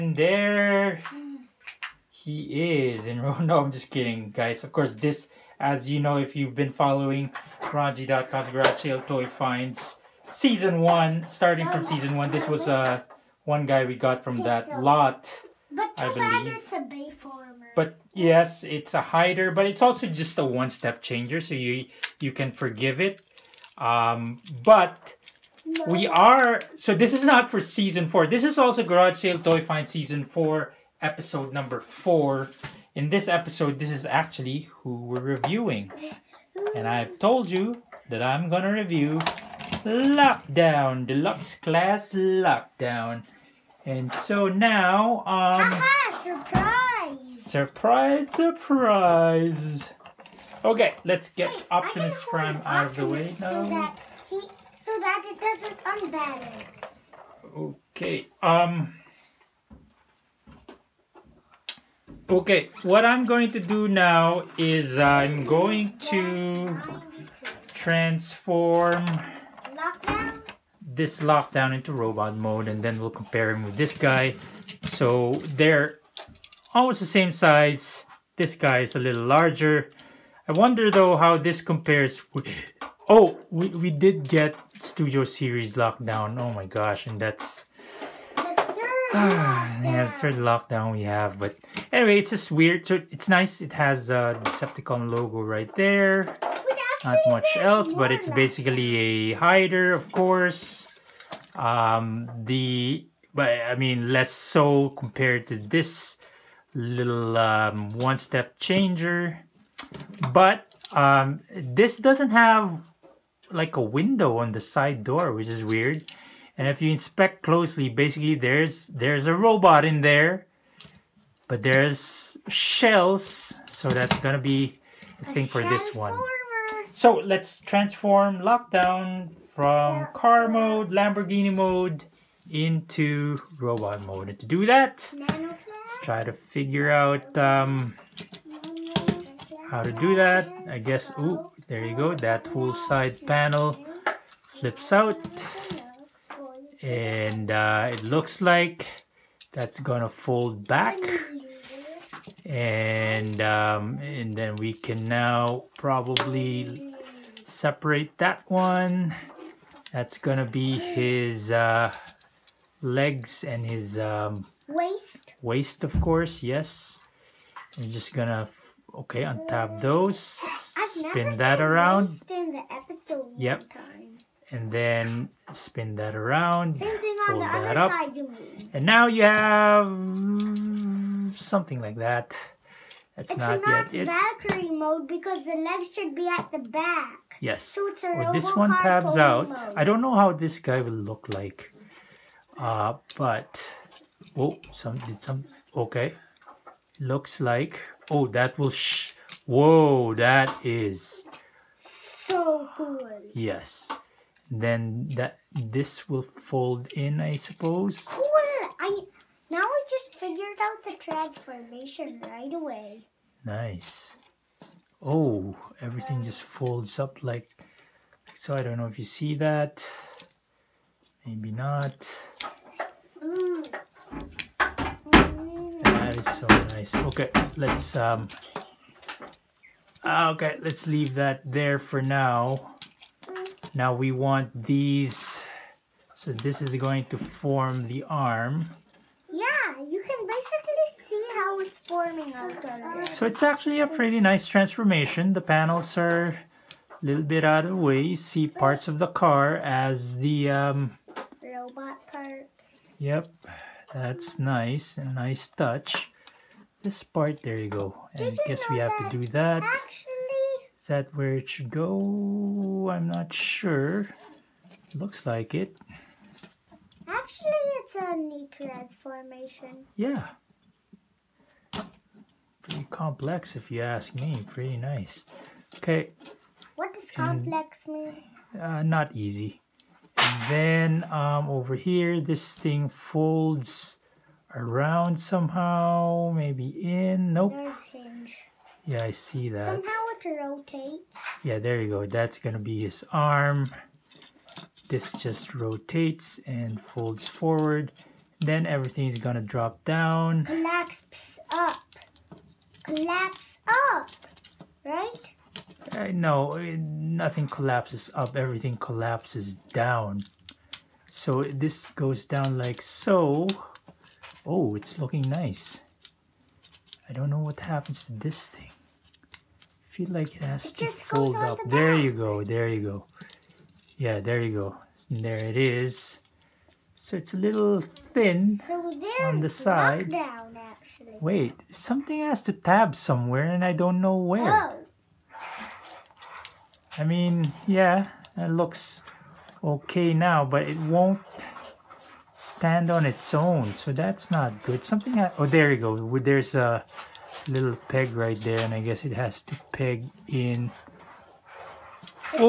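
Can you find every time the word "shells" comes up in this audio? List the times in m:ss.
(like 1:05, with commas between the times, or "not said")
2:02.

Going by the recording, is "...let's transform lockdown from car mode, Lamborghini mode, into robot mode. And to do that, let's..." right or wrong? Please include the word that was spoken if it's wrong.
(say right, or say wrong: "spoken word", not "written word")
right.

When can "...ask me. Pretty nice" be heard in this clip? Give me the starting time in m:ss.
4:33.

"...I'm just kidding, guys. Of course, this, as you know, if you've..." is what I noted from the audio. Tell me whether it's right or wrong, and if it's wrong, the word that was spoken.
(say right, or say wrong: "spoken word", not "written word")
right.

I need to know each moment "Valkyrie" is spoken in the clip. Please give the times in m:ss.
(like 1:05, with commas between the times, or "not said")
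3:04.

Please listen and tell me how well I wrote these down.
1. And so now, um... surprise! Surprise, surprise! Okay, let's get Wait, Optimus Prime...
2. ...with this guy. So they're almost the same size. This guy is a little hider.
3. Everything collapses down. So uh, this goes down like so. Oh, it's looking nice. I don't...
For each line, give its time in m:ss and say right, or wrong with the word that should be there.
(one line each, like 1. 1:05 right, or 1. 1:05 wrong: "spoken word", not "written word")
1. 0:43 right
2. 1:13 wrong: "larger", not "hider"
3. 5:08 right.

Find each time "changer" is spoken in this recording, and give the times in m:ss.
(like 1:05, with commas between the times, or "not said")
0:21, 1:48.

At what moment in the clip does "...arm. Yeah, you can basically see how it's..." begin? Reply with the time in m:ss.
3:58.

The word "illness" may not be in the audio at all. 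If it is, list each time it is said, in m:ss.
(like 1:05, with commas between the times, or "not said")
not said.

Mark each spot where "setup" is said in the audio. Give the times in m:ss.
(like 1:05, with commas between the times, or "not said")
not said.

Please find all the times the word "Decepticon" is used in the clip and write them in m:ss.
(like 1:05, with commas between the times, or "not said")
1:34.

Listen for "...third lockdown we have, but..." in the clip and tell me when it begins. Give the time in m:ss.
1:30.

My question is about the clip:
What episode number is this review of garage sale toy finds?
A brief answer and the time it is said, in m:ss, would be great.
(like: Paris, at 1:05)
4, at 0:31.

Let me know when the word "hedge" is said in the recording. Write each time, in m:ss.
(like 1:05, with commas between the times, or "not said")
not said.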